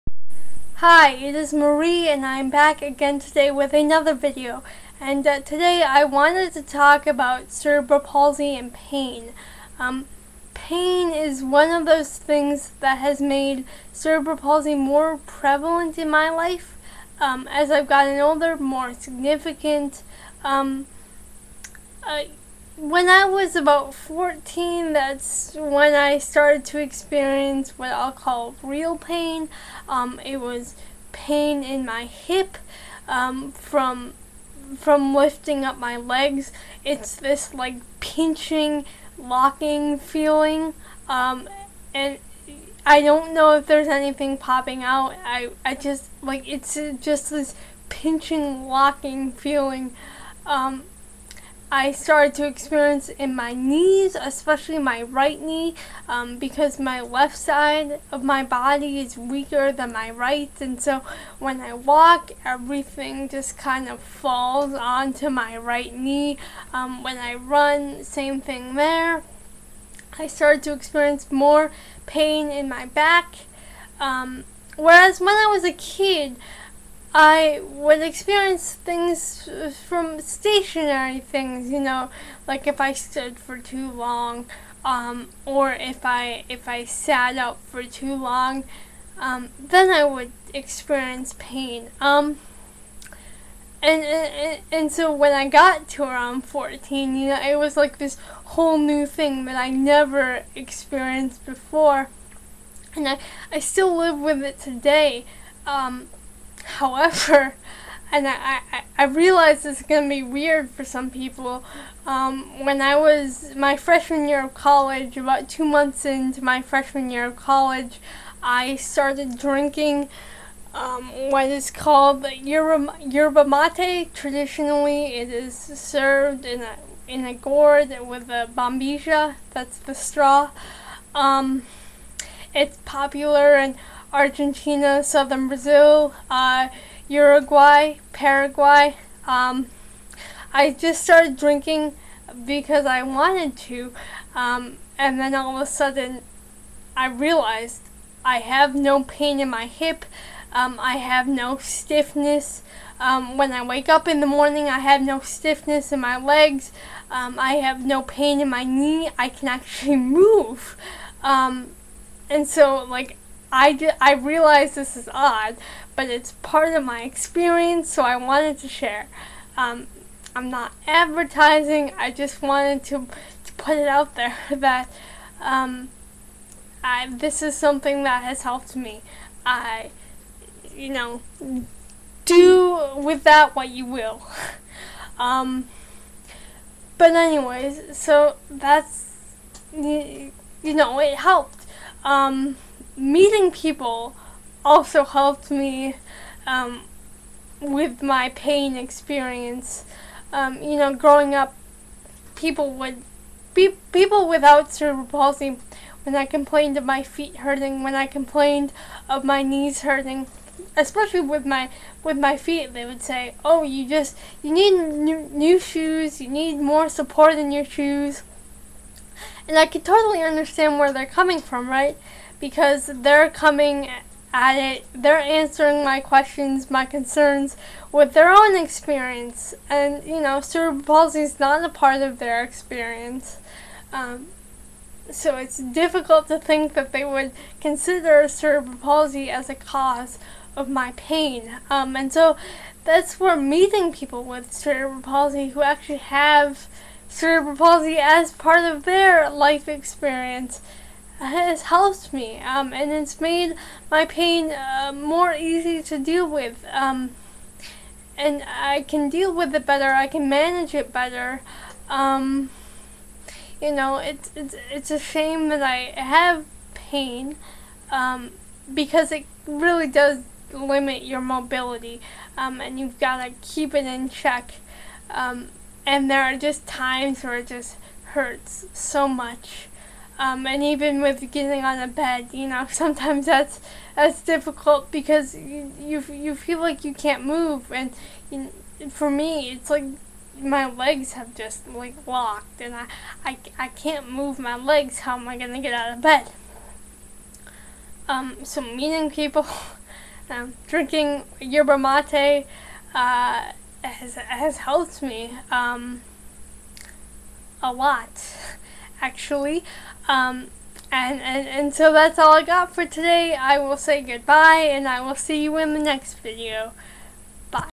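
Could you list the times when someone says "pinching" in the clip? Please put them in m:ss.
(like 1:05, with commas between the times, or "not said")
0:37, 0:47.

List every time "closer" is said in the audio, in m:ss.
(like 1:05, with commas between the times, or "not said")
not said.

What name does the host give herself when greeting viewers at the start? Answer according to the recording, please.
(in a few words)
Marie.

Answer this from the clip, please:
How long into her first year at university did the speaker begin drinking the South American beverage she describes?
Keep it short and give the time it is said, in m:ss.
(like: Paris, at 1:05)
2 months, at 1:55.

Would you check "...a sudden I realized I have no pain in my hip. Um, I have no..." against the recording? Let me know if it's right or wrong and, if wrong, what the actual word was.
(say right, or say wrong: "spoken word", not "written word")
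right.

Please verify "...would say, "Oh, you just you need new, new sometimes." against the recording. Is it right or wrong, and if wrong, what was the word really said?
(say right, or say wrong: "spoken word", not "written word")
wrong: "shoes", not "sometimes".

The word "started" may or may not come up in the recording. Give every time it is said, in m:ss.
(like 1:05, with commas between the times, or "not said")
0:26, 0:51, 1:10, 1:58, 2:21.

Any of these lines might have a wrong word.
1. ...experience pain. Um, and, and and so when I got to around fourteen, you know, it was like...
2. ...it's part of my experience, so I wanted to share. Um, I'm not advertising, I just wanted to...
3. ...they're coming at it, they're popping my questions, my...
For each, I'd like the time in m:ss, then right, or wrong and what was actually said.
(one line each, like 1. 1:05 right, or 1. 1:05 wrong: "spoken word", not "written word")
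1. 1:30 right
2. 2:46 right
3. 3:42 wrong: "answering", not "popping".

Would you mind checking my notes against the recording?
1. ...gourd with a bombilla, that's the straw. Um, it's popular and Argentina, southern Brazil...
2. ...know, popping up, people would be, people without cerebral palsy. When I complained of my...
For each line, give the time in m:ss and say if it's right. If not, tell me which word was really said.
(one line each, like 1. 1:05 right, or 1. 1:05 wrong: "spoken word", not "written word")
1. 2:07 right
2. 3:20 wrong: "growing", not "popping".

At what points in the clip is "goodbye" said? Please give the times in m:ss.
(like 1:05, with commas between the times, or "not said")
5:14.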